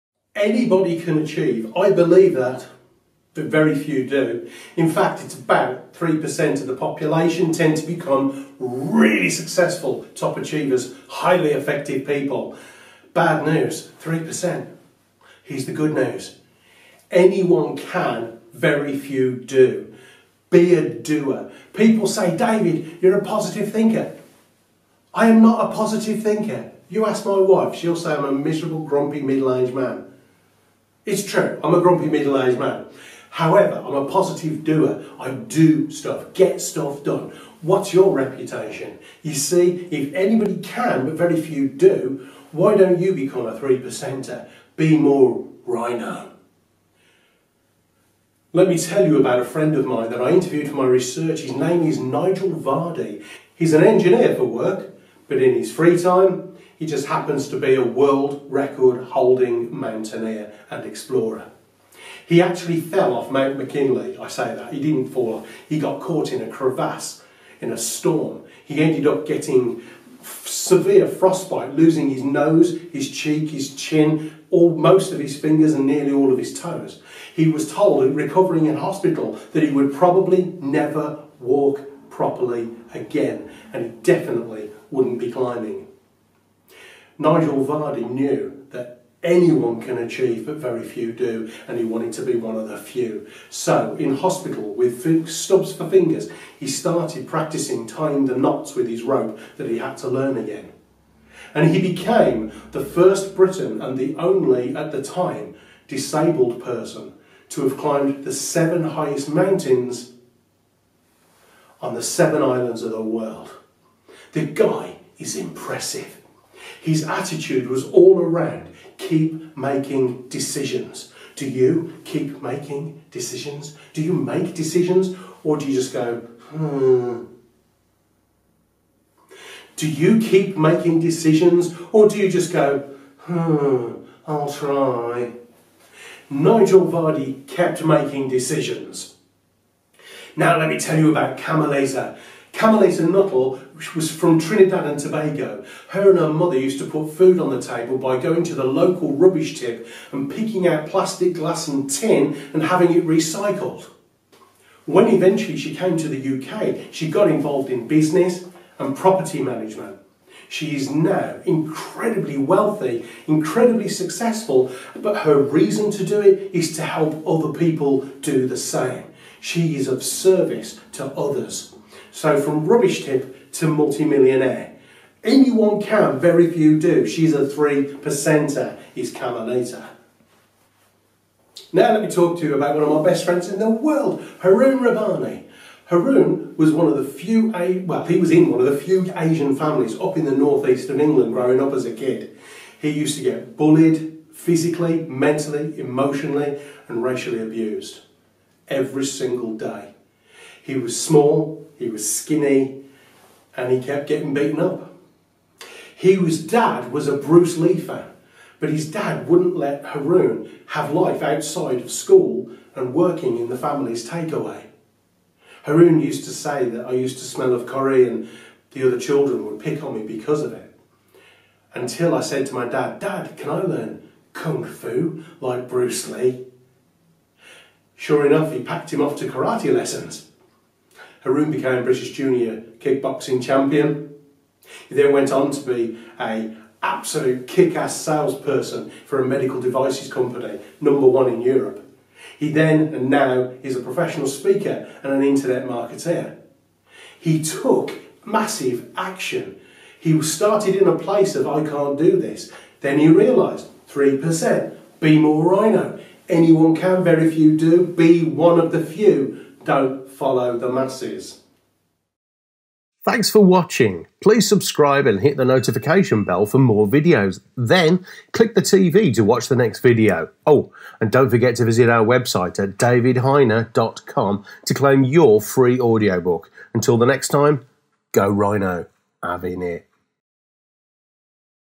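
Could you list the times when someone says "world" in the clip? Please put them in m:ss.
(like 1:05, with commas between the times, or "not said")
0:57, 1:53, 3:03.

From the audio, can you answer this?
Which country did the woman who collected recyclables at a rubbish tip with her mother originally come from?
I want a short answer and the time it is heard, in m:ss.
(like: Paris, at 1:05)
Trinidad and Tobago, at 2:24.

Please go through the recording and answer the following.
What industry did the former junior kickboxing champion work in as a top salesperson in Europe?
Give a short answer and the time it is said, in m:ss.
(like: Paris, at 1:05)
Medical devices, at 3:59.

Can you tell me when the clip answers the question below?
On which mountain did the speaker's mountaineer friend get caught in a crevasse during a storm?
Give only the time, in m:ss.
1:03.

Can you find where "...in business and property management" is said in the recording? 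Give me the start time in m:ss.
2:37.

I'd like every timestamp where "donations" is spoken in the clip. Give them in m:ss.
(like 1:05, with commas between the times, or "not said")
not said.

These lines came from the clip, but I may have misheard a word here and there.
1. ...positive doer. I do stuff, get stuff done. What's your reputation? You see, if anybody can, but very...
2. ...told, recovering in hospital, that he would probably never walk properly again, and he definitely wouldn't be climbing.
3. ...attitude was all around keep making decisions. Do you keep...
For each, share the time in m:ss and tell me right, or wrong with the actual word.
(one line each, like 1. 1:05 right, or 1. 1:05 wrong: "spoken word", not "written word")
1. 0:34 right
2. 1:17 right
3. 1:57 right.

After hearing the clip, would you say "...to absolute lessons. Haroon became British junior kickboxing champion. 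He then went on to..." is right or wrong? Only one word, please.
wrong.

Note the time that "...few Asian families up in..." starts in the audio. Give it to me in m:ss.
3:08.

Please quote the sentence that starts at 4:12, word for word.
Then he realised, 3%, be more rhino.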